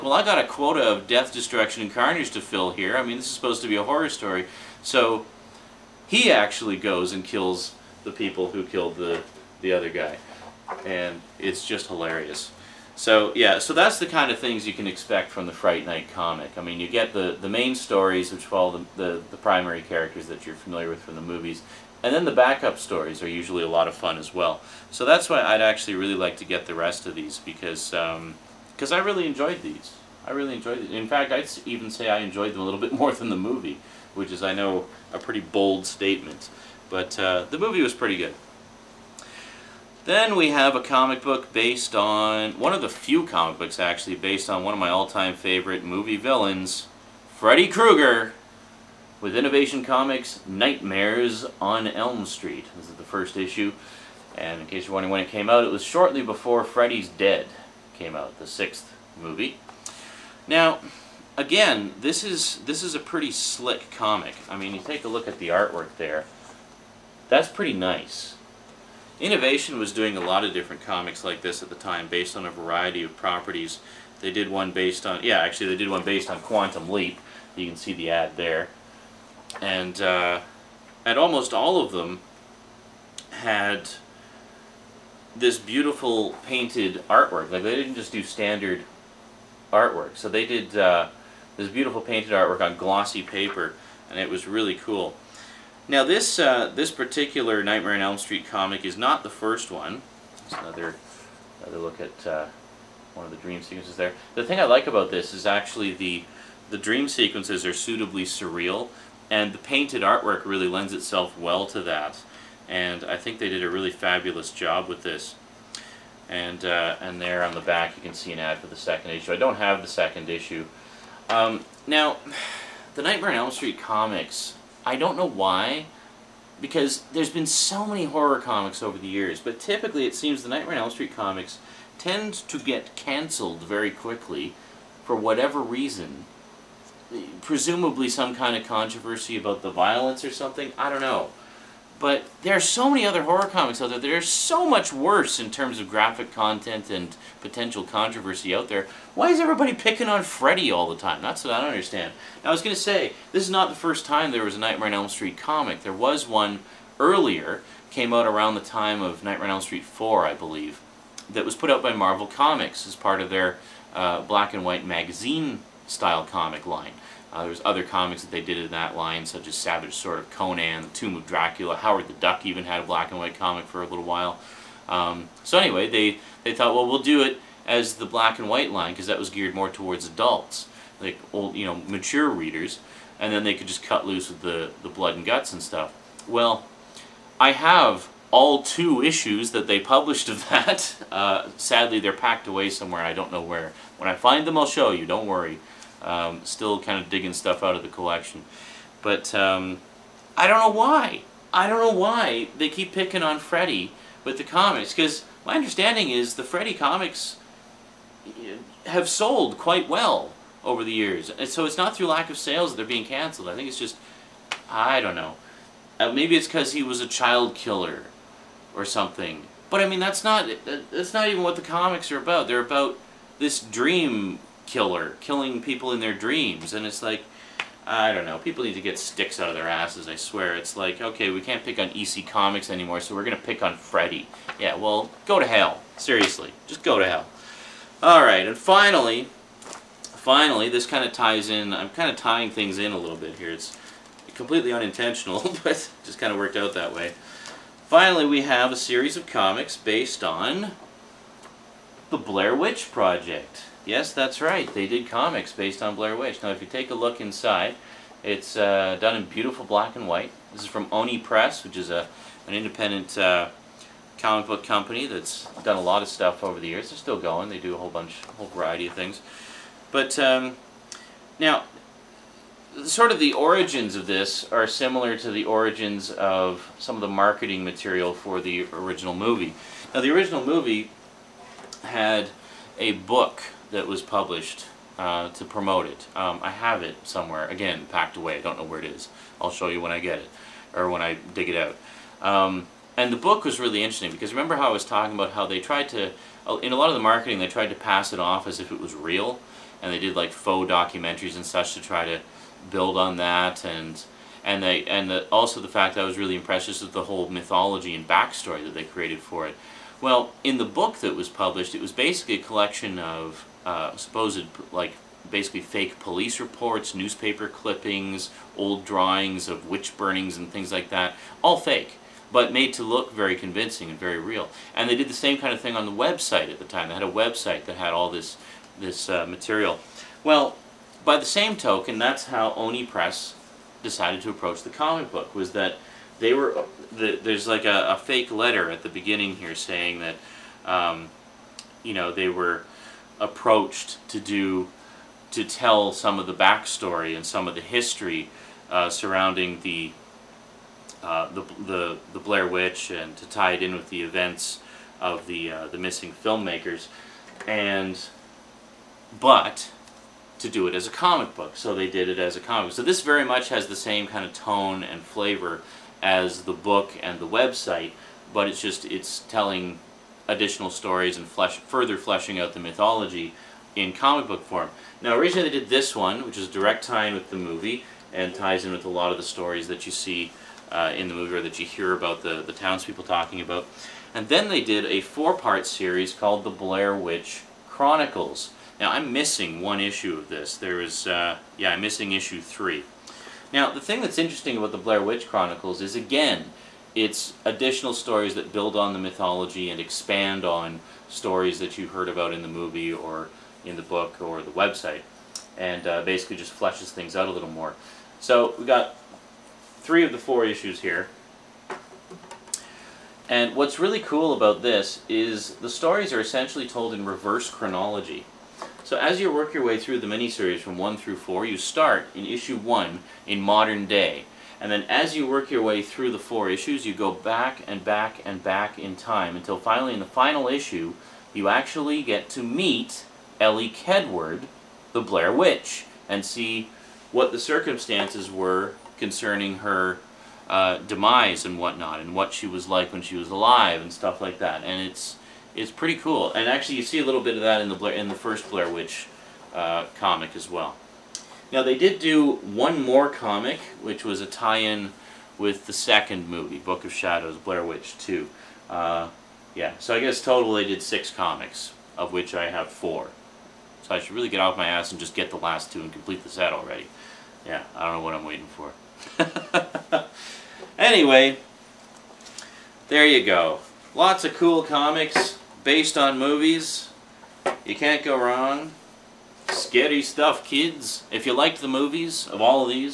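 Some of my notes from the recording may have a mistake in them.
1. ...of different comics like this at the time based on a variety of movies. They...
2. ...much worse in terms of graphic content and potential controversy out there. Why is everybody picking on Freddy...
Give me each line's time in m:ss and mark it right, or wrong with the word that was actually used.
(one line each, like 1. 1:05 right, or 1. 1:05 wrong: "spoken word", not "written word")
1. 1:10 wrong: "properties", not "movies"
2. 2:24 right.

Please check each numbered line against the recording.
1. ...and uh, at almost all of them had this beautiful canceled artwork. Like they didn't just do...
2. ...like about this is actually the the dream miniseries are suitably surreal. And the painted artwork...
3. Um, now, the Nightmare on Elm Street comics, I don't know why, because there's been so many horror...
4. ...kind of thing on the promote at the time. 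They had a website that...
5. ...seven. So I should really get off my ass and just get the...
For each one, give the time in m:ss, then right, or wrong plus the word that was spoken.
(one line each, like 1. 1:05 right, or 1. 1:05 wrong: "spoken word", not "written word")
1. 1:19 wrong: "painted", not "canceled"
2. 1:44 wrong: "sequences", not "miniseries"
3. 2:01 right
4. 5:25 wrong: "website", not "promote"
5. 7:42 wrong: "four", not "seven".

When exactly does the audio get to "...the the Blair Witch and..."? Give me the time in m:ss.
5:51.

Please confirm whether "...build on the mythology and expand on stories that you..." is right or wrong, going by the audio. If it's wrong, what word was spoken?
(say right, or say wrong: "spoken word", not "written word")
right.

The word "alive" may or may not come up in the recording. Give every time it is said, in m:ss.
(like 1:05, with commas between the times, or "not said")
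7:23.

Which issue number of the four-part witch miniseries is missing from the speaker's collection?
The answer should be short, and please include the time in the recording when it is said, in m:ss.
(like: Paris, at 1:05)
3, at 6:32.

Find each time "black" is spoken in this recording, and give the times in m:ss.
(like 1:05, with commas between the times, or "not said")
2:44, 2:52, 2:58, 4:19.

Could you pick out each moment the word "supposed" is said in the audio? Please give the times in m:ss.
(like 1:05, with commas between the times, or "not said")
0:03, 5:13.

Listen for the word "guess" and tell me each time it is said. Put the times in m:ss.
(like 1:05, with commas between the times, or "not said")
7:40.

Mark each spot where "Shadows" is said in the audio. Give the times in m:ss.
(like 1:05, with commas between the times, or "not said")
7:36.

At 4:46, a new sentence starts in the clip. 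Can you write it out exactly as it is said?
Um, I have it somewhere, again, packed away.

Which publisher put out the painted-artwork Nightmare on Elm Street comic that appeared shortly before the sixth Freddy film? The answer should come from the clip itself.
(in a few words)
Innovation Comics.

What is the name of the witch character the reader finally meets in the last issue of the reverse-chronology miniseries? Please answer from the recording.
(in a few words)
Elly Kedward.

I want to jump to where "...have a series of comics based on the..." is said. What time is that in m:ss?
4:08.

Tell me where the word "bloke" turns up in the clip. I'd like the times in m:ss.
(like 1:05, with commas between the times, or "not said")
not said.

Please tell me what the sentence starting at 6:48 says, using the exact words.
So we got three of the four issues here.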